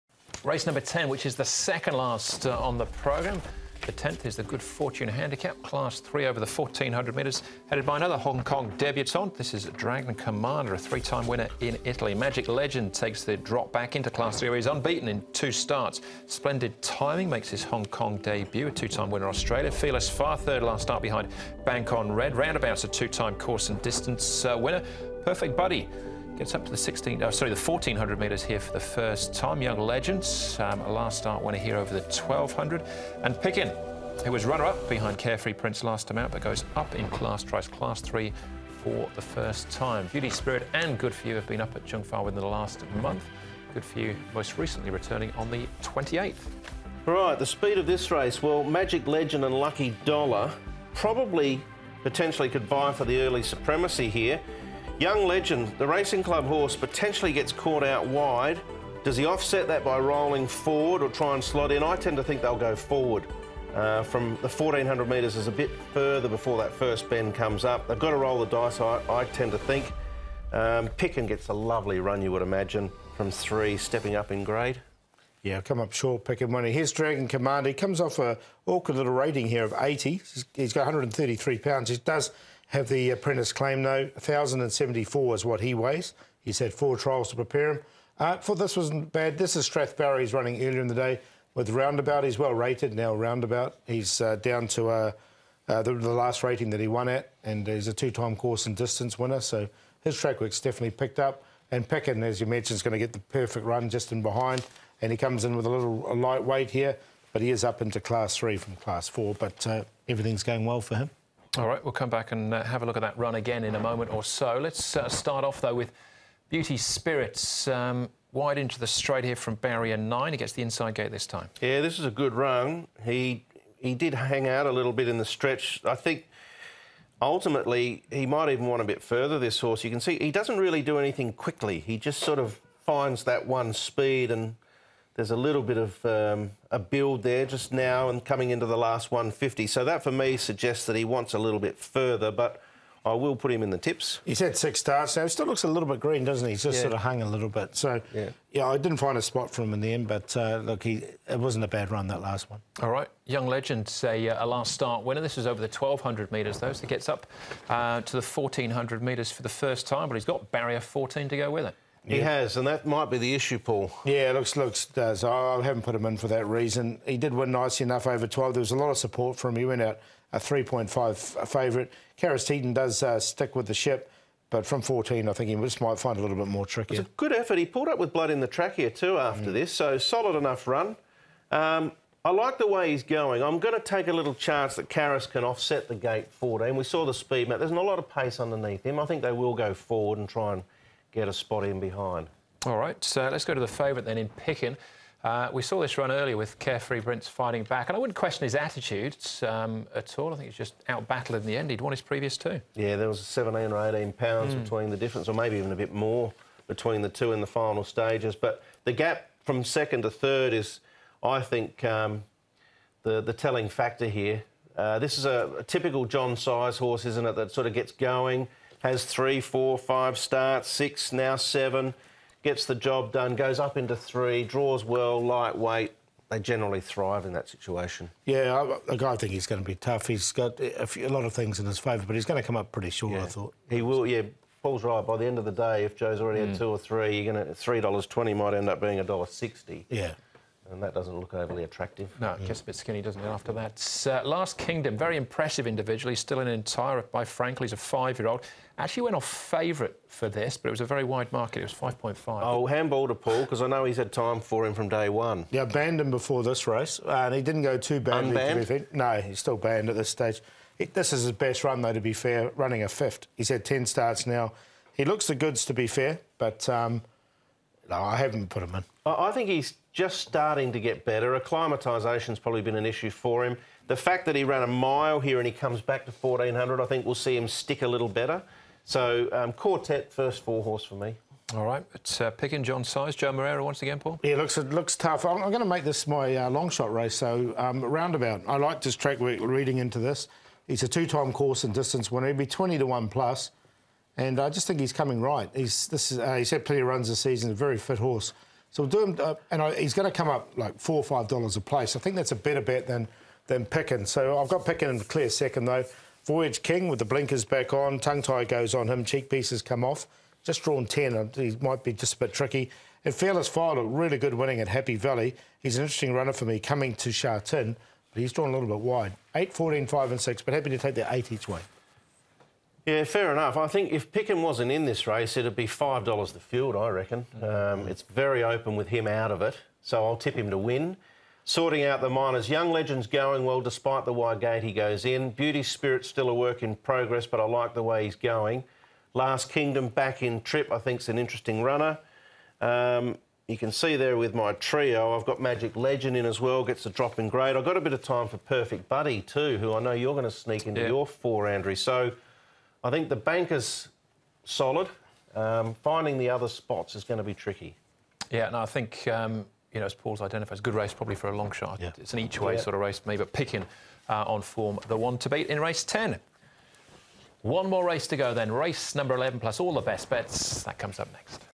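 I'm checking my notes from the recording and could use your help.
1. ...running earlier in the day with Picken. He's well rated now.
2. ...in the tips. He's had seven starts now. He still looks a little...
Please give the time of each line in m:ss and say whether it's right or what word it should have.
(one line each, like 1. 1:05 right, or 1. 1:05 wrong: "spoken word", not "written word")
1. 1:30 wrong: "Roundabout", not "Picken"
2. 2:23 wrong: "six", not "seven".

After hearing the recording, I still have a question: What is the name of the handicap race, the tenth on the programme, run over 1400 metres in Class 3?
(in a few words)
Good Fortune Handicap.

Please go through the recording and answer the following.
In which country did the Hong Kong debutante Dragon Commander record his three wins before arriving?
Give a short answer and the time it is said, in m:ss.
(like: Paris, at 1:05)
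Italy, at 0:10.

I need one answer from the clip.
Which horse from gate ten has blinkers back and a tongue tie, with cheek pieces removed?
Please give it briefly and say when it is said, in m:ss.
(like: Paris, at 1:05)
Voyage King, at 5:06.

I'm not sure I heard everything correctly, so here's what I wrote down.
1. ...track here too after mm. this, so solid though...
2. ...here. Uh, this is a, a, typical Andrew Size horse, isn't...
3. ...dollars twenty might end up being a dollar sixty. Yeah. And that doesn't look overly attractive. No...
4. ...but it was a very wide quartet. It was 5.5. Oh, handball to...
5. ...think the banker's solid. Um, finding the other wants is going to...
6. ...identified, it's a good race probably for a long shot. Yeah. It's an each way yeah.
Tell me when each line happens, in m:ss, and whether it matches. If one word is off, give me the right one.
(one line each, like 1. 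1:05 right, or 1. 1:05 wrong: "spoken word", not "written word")
1. 2:58 wrong: "enough", not "though"
2. 3:34 wrong: "John", not "Andrew"
3. 3:57 right
4. 4:10 wrong: "market", not "quartet"
5. 5:52 wrong: "spots", not "wants"
6. 6:00 right.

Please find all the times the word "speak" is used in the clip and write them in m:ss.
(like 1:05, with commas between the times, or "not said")
not said.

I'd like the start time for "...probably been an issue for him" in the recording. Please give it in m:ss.
4:32.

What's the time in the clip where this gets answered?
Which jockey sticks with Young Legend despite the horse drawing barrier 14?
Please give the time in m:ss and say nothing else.
2:52.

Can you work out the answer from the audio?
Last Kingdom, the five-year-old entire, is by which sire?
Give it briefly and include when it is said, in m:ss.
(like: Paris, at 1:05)
Frankel, at 4:07.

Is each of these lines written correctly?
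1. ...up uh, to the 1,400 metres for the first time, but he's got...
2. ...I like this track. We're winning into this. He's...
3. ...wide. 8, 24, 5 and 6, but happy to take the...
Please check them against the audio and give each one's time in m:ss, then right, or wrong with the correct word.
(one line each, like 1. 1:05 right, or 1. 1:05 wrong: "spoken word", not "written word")
1. 2:37 right
2. 4:48 wrong: "reading", not "winning"
3. 5:18 wrong: "14", not "24".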